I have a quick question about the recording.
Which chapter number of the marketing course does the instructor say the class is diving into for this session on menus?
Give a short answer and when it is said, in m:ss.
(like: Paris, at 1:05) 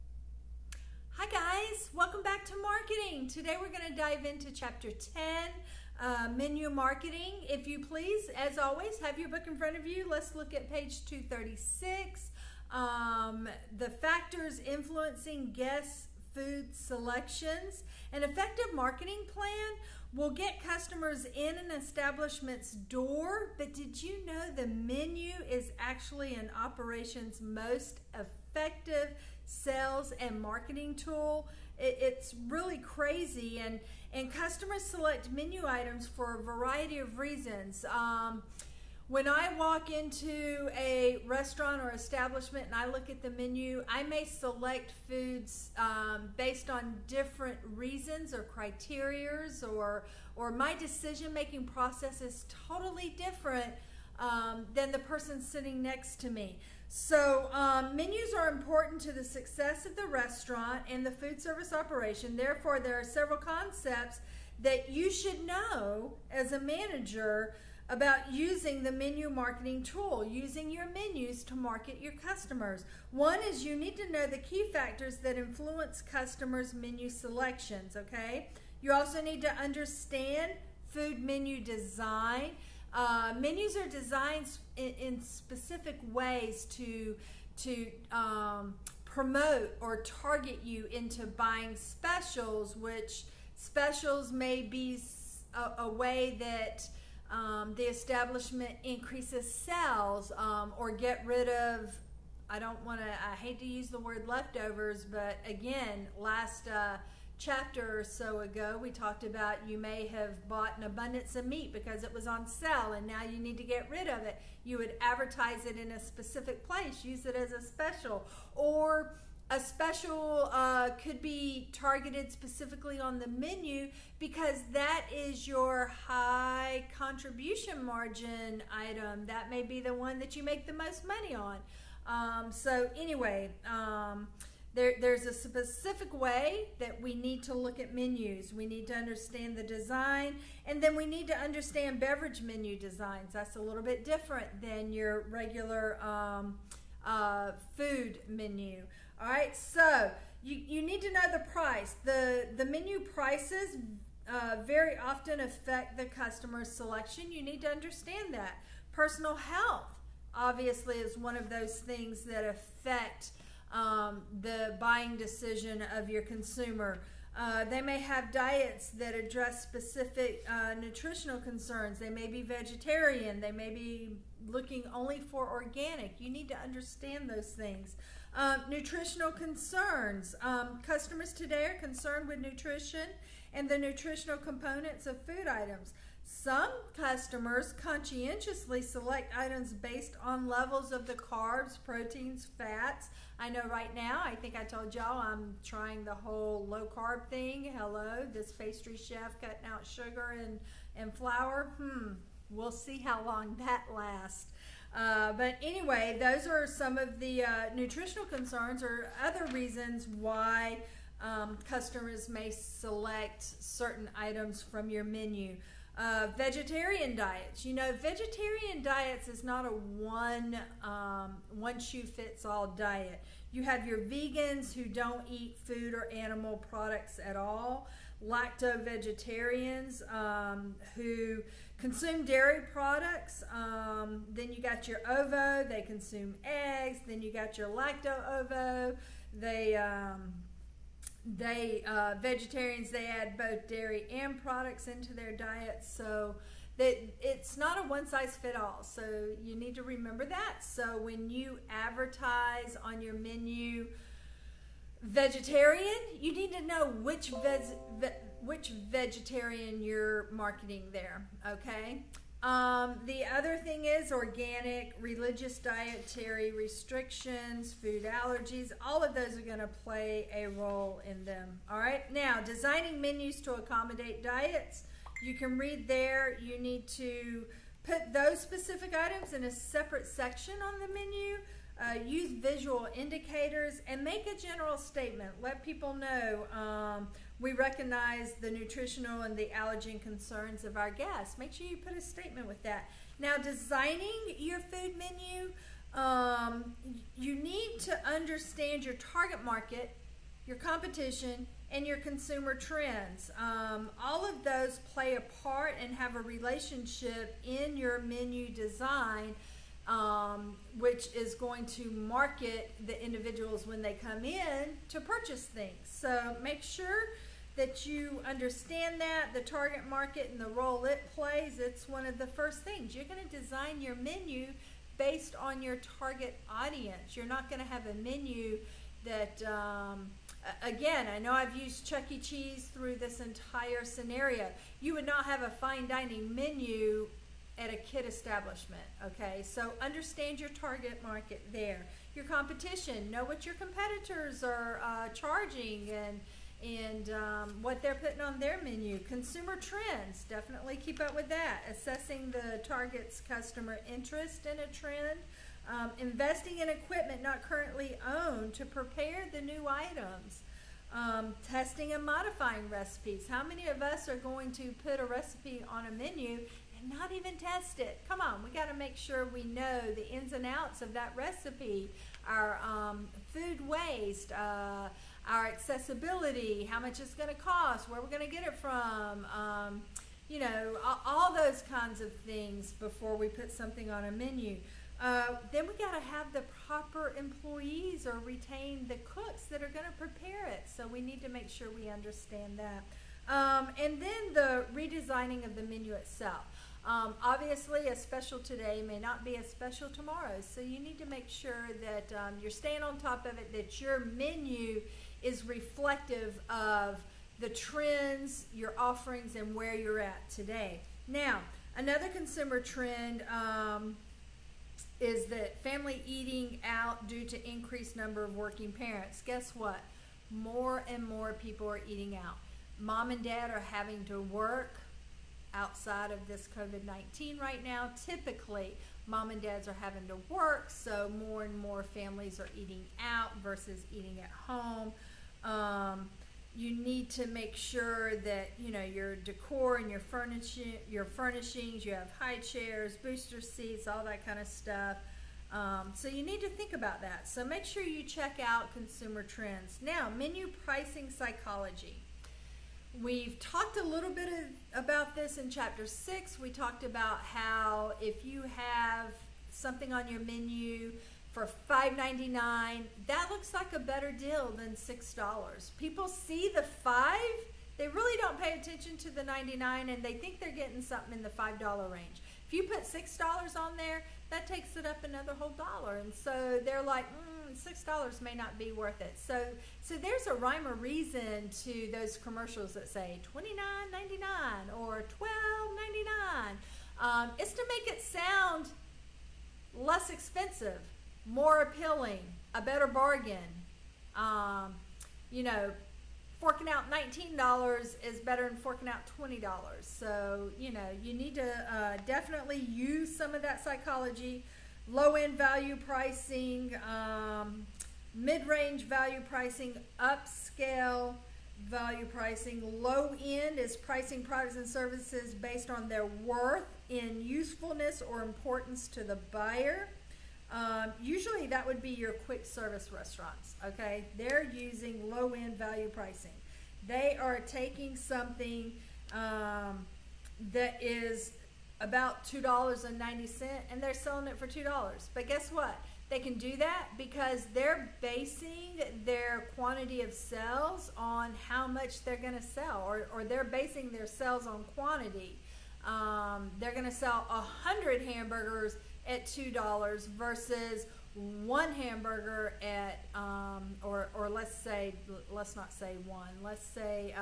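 10, at 0:04.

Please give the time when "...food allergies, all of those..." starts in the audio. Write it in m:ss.
4:27.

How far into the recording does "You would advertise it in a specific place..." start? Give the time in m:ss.
1:54.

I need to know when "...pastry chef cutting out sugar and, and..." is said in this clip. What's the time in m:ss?
3:18.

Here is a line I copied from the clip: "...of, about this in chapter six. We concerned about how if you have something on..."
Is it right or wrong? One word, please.
wrong.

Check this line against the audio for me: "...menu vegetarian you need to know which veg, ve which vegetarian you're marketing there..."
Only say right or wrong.
right.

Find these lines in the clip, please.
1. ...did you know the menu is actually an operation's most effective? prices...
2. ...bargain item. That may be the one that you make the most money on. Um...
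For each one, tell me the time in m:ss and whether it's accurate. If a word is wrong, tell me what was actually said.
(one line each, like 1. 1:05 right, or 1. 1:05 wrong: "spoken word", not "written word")
1. 0:23 wrong: "sales", not "prices"
2. 2:07 wrong: "margin", not "bargain".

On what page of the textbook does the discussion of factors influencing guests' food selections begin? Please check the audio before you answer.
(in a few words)
236.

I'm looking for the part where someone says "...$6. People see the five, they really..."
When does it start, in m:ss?
7:44.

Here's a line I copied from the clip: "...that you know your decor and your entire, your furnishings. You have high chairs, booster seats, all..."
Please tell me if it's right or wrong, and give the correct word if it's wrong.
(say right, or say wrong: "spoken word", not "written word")
wrong: "furniture", not "entire".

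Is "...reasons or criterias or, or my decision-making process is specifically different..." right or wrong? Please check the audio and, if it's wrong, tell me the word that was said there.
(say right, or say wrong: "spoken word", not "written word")
wrong: "totally", not "specifically".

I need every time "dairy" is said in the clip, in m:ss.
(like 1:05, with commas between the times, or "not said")
3:52, 4:03.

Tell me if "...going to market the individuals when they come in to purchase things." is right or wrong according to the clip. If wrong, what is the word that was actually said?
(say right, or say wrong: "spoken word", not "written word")
right.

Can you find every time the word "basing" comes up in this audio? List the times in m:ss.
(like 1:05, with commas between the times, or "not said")
8:58, 9:03.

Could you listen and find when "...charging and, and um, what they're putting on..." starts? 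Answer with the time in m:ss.
5:45.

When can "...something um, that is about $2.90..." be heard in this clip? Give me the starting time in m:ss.
8:47.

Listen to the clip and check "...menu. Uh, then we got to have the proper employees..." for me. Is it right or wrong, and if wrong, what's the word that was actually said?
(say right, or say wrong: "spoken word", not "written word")
right.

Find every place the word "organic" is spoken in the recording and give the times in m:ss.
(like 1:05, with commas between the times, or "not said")
2:55, 4:24.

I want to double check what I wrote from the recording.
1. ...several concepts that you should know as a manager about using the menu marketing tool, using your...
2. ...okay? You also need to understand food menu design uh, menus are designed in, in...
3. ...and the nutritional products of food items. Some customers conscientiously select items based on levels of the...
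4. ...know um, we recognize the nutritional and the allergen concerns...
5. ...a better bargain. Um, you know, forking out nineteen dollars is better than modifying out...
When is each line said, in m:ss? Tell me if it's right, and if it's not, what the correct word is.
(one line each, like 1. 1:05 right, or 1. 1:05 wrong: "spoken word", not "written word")
1. 1:03 right
2. 1:17 right
3. 3:03 wrong: "components", not "products"
4. 4:45 right
5. 8:12 wrong: "forking", not "modifying".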